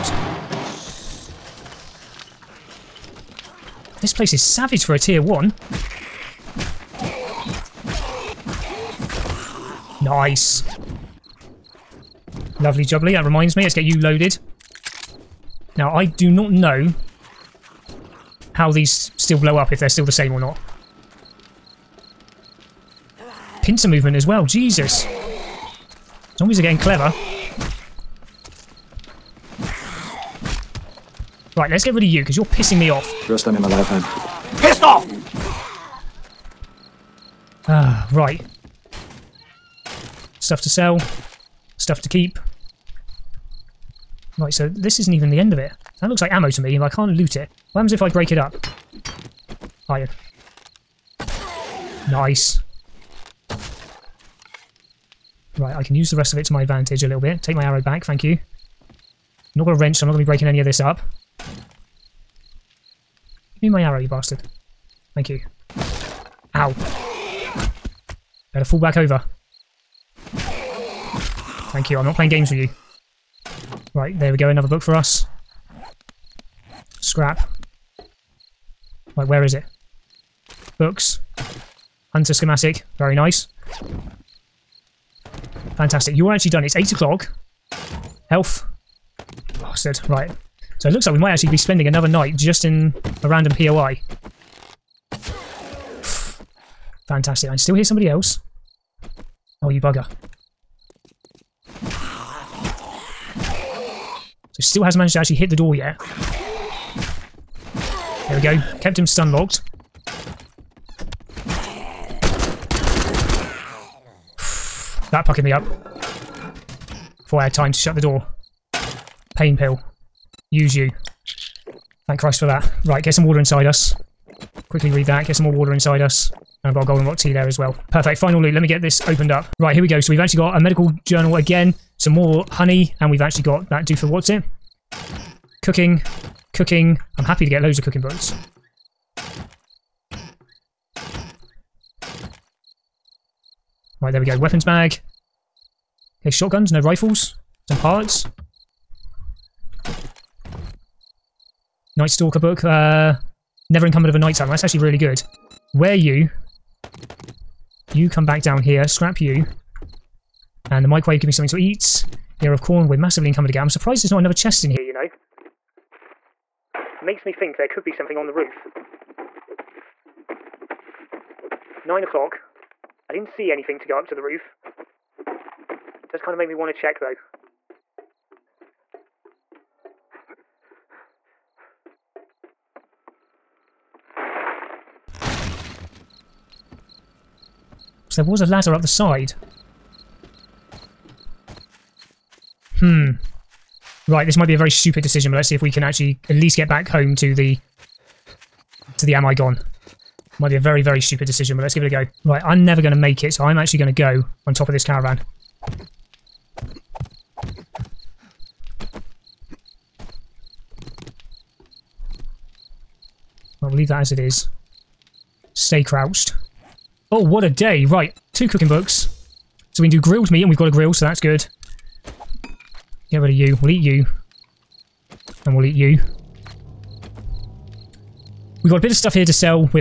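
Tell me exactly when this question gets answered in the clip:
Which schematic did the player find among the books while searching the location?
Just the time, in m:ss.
1:22.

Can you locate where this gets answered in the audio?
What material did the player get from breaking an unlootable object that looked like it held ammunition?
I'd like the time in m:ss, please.
0:49.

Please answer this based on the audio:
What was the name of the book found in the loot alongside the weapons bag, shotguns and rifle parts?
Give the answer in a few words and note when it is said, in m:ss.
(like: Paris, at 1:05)
Night Stalker, at 2:31.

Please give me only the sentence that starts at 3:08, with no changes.
there was a ladder up the side.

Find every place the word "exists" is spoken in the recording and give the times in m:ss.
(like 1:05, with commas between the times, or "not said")
not said.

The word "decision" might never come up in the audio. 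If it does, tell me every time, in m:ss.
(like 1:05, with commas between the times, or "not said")
3:15, 3:21.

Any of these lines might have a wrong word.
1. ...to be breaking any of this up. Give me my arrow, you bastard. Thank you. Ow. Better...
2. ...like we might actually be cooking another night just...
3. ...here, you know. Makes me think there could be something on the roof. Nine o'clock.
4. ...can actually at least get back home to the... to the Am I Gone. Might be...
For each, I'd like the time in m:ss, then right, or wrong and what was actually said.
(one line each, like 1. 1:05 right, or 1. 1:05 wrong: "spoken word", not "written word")
1. 1:00 right
2. 1:31 wrong: "spending", not "cooking"
3. 2:44 right
4. 3:15 right.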